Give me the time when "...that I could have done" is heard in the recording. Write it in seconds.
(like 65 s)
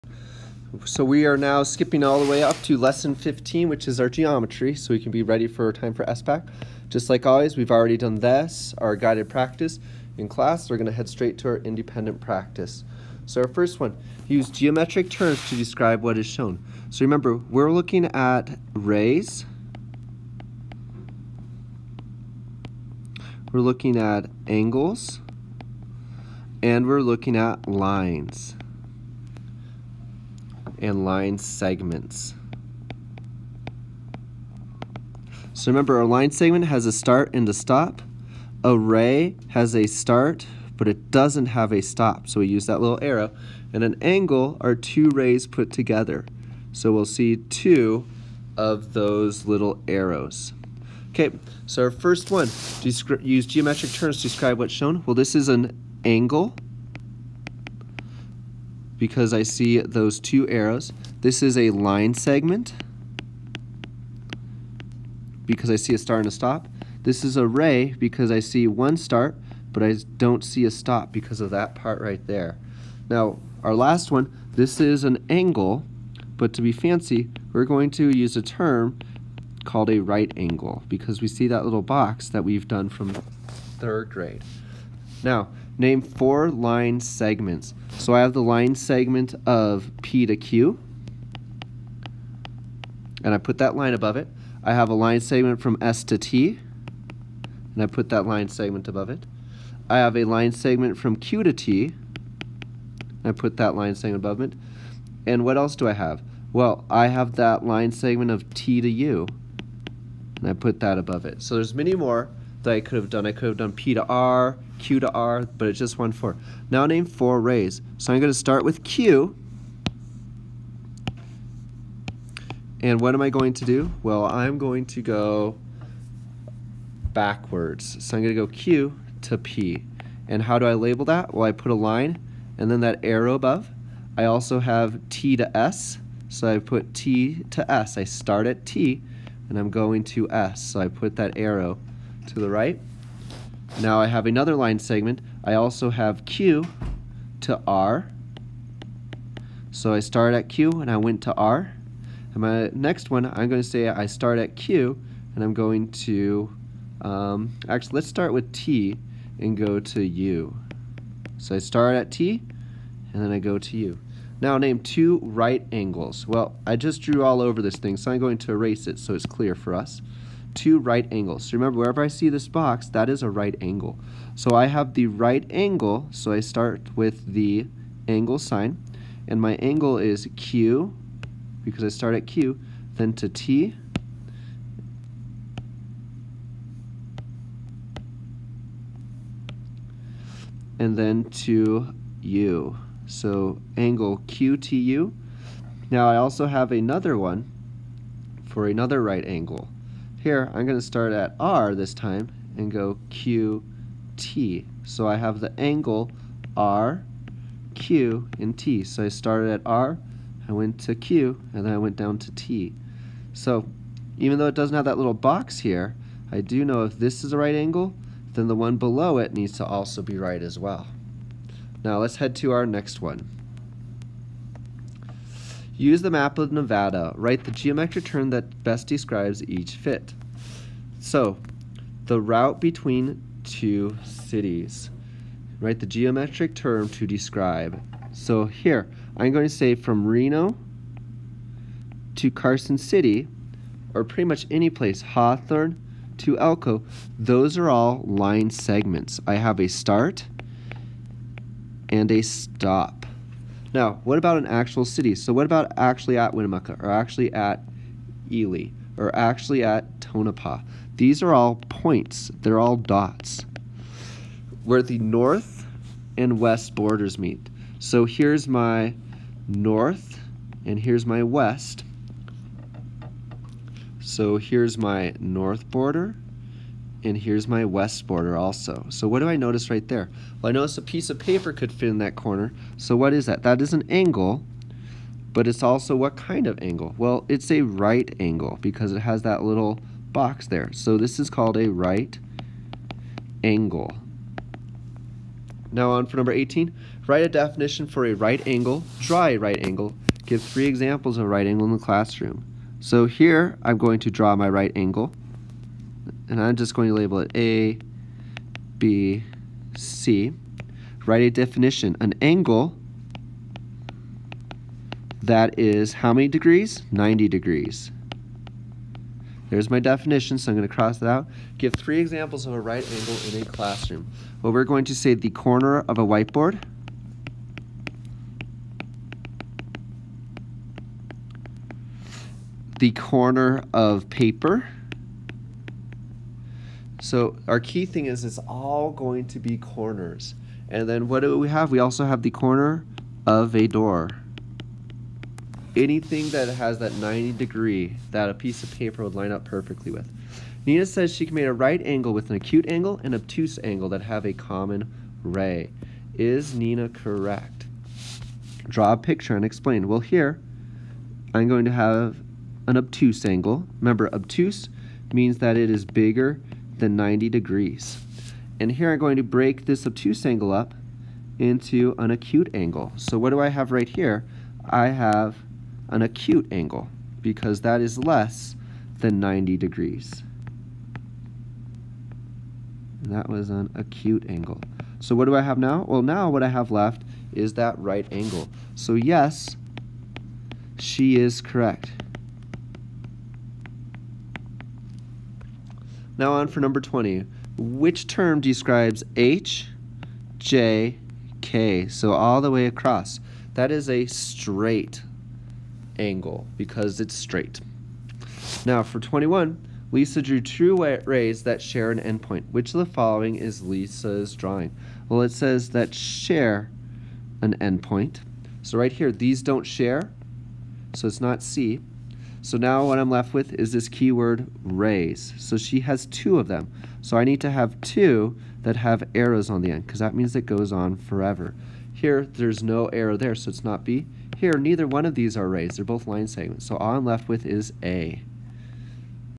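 112 s.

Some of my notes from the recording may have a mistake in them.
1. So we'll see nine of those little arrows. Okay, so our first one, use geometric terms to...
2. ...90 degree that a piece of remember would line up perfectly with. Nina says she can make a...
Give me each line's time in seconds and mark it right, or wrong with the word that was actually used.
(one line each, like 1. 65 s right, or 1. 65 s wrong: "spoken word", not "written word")
1. 46 s wrong: "two", not "nine"
2. 346 s wrong: "paper", not "remember".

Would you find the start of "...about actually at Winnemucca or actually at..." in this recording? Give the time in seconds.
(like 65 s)
255 s.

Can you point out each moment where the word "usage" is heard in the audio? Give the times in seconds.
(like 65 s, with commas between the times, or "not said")
not said.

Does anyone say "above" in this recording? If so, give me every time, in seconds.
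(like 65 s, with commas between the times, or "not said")
93 s, 98 s, 104 s, 110 s, 133 s.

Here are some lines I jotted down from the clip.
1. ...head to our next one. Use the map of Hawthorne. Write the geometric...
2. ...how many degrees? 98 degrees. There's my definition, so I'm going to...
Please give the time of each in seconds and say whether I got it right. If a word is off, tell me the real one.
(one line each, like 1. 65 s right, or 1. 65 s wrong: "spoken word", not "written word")
1. 222 s wrong: "Nevada", not "Hawthorne"
2. 315 s wrong: "90", not "98".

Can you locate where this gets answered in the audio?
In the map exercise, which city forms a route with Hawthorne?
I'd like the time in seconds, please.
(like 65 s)
246 s.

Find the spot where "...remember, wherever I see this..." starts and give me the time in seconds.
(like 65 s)
171 s.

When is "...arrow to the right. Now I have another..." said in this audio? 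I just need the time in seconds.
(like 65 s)
141 s.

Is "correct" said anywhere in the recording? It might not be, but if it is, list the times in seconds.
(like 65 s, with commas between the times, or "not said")
356 s, 391 s.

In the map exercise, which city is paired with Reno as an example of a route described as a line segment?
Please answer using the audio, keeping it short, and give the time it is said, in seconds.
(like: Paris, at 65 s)
Carson City, at 242 s.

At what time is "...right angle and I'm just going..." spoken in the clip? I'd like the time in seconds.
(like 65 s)
304 s.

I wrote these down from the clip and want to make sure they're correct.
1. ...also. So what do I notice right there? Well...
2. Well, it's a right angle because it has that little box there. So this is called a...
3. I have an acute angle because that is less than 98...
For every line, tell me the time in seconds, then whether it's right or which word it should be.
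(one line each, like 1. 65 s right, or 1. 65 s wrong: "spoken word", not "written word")
1. 278 s right
2. 286 s right
3. 374 s wrong: "90", not "98".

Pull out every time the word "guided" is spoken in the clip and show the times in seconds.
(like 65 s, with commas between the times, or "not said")
8 s.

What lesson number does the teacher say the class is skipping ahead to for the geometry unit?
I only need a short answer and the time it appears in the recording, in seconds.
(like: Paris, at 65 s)
15, at 2 s.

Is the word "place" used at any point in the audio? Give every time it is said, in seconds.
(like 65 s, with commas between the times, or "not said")
244 s.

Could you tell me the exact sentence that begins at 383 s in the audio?
And that was an acute angle.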